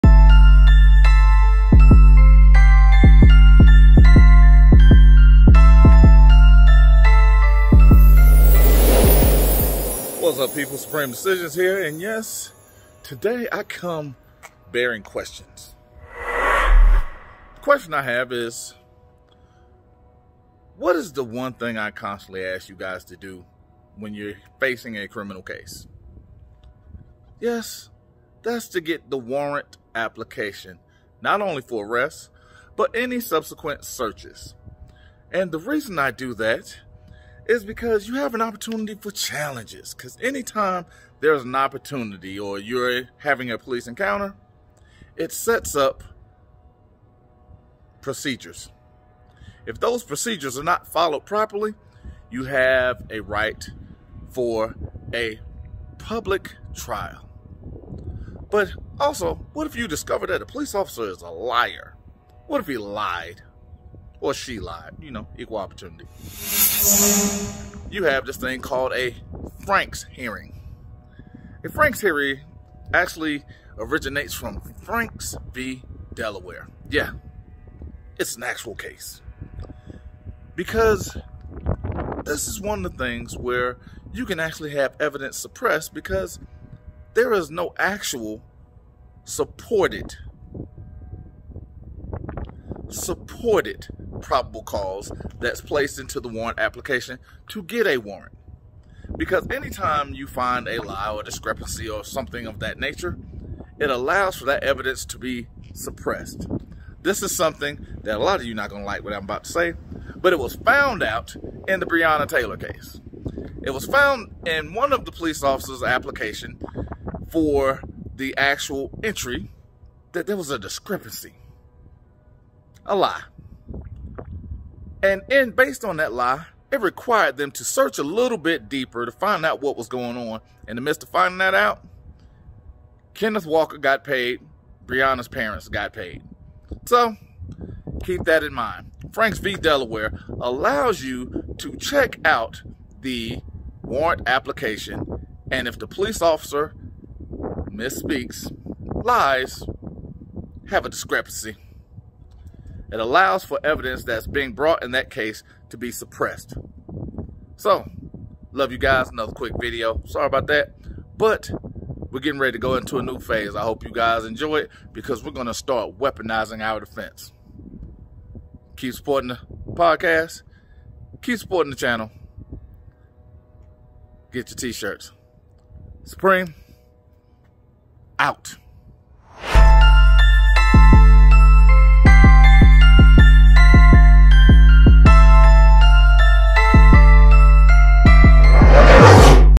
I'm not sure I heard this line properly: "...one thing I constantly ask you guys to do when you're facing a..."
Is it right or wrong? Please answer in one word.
right.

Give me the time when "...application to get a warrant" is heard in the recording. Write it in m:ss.
1:36.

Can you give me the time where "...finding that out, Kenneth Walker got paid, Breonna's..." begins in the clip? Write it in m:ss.
2:11.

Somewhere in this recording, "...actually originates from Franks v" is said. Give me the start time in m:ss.
1:12.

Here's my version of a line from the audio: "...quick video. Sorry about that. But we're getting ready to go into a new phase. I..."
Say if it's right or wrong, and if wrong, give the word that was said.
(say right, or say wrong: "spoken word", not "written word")
right.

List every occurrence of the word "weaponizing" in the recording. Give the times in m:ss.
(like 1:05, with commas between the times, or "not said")
2:45.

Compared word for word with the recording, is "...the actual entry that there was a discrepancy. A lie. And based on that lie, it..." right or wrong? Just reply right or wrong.
right.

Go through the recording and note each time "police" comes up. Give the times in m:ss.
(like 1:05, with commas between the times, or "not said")
0:43, 1:00, 1:55, 2:25.